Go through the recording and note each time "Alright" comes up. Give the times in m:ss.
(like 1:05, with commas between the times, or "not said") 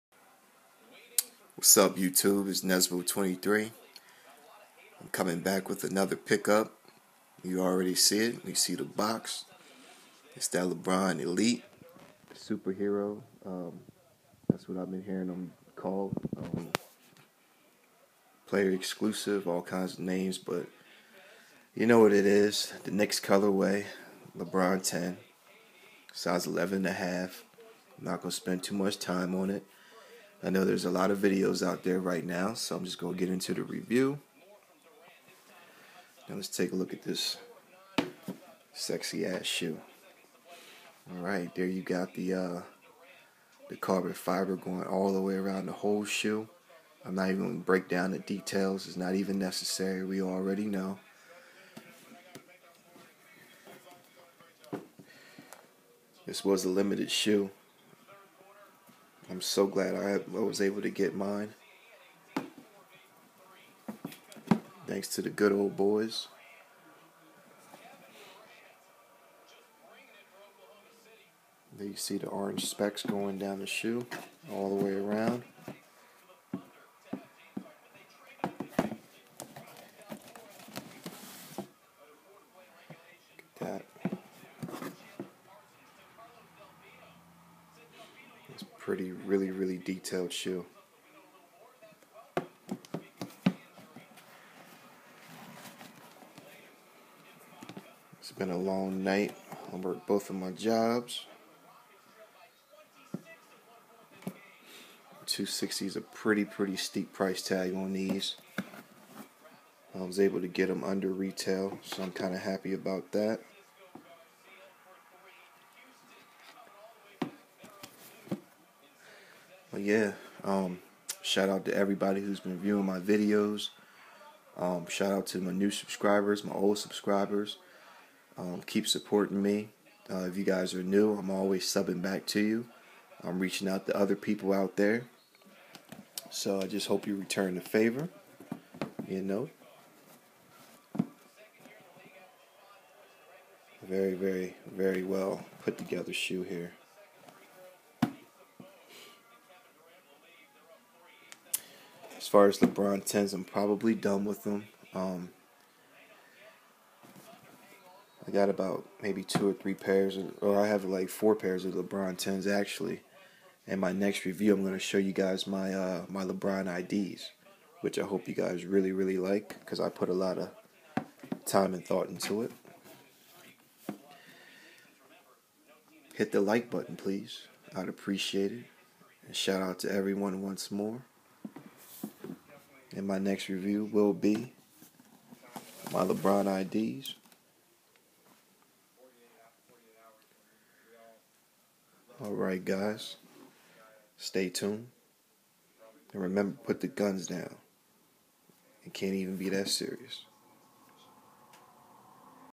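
0:41.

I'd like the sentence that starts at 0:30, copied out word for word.
I know there's a lot of videos out there right now, so I'm just going to get into the review.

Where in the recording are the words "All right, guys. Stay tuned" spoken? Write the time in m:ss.
3:12.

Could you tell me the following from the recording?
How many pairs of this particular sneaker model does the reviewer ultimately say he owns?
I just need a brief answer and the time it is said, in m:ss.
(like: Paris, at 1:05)
4, at 2:41.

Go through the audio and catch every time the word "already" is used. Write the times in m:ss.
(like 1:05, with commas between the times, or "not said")
0:07, 0:50.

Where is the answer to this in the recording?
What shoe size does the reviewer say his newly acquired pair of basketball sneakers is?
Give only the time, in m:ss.
0:26.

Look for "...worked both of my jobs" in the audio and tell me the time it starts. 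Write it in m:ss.
1:39.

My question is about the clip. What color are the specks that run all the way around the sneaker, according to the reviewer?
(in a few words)
Orange.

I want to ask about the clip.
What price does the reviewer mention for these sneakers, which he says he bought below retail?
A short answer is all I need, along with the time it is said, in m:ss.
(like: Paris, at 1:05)
260, at 1:45.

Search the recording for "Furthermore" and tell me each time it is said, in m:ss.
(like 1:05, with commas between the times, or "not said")
not said.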